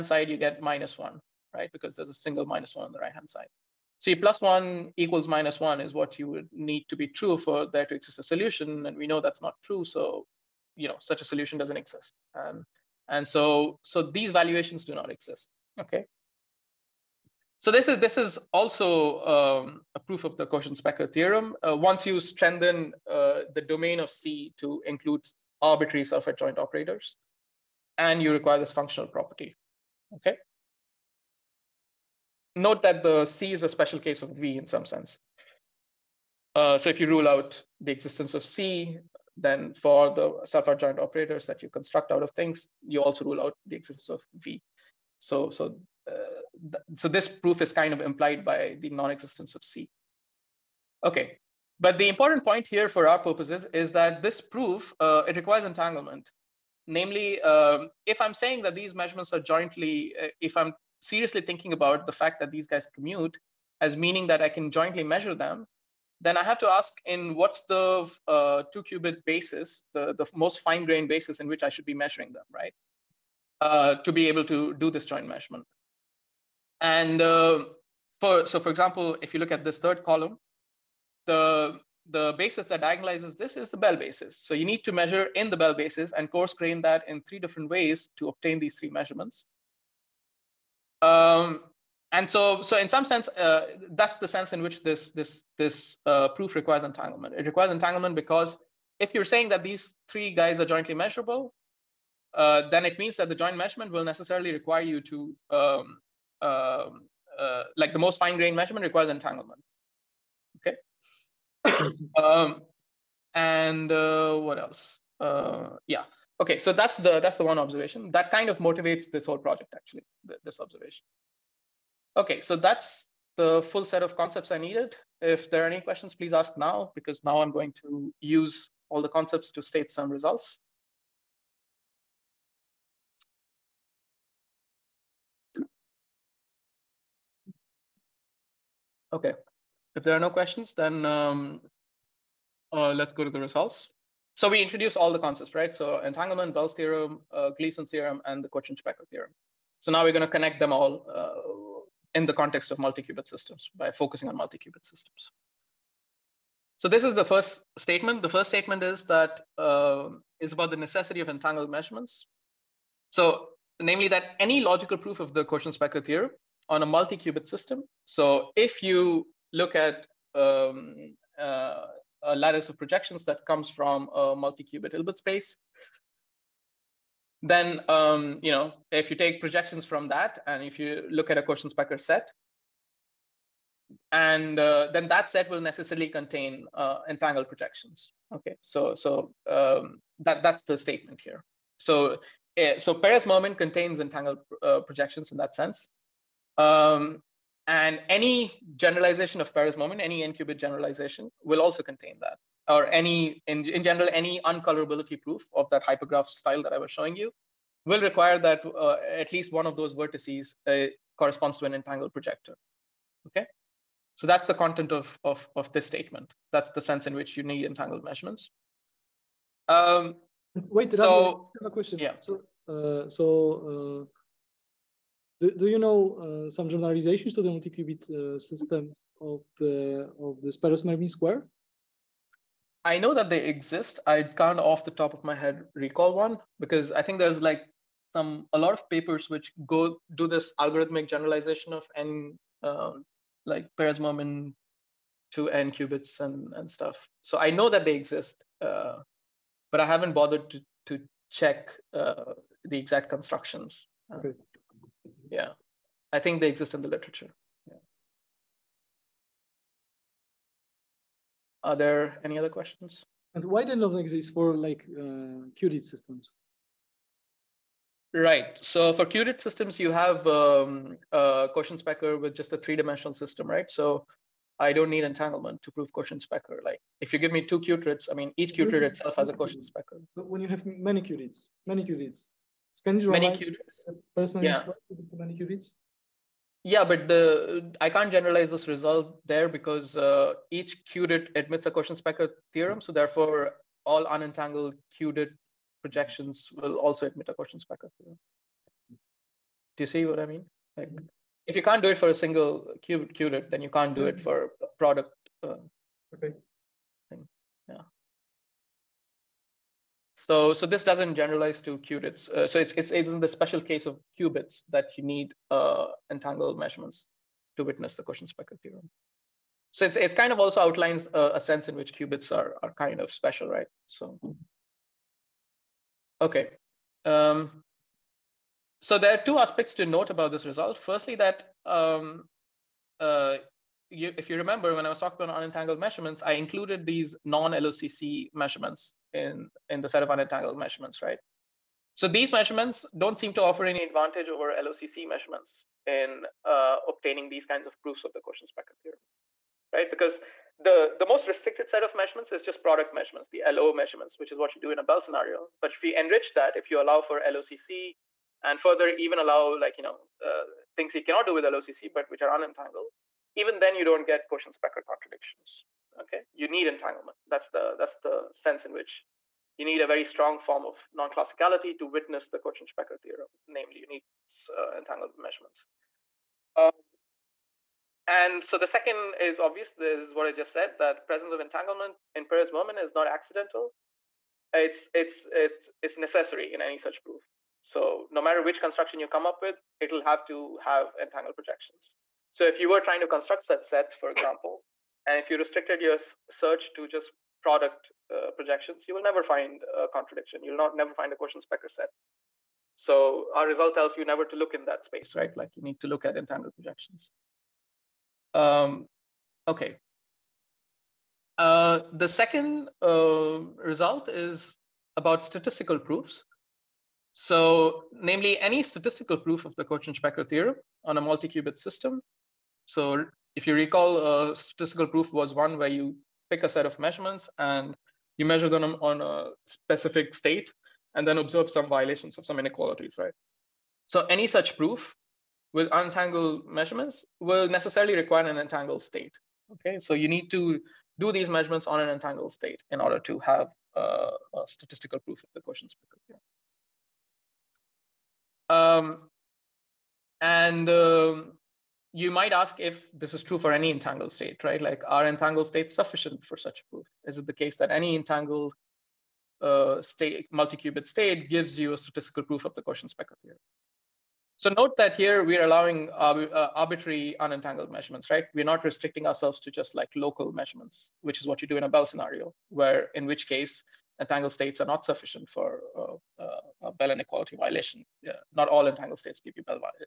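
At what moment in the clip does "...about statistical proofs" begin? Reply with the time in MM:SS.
06:54.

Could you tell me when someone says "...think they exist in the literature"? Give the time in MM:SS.
04:16.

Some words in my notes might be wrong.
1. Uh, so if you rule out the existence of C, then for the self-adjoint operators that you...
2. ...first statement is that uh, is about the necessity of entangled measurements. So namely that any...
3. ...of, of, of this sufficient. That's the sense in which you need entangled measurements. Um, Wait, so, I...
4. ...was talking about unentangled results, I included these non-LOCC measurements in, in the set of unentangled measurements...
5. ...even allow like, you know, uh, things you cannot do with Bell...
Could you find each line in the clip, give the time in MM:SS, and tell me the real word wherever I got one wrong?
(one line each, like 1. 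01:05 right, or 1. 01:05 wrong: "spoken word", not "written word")
1. 00:36 right
2. 02:38 right
3. 03:34 wrong: "statement", not "sufficient"
4. 05:34 wrong: "measurements", not "results"
5. 05:58 wrong: "LOCC", not "Bell".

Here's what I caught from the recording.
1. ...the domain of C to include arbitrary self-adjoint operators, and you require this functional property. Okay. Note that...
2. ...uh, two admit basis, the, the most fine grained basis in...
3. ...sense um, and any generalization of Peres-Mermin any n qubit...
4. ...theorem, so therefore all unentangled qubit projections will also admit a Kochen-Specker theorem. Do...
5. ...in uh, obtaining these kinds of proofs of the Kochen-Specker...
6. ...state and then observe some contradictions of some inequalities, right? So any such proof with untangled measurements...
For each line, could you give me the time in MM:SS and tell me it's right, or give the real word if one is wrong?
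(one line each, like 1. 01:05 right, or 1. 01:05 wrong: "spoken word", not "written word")
1. 00:23 right
2. 01:08 wrong: "qubit", not "admit"
3. 03:15 right
4. 04:52 right
5. 05:45 right
6. 07:10 wrong: "violations", not "contradictions".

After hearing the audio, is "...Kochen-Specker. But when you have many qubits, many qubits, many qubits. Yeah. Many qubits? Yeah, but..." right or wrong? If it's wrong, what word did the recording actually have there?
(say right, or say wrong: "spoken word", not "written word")
right.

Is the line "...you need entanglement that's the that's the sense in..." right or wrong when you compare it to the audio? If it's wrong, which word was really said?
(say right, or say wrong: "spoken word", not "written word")
right.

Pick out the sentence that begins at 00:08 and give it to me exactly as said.
And we know that's not true.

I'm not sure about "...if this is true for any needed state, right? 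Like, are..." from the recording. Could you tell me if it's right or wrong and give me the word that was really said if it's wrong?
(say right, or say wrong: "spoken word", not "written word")
wrong: "entangled", not "needed".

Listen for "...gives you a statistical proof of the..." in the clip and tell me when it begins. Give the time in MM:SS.
07:41.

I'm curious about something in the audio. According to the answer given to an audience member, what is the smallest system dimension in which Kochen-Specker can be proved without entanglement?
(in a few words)
Three-dimensional.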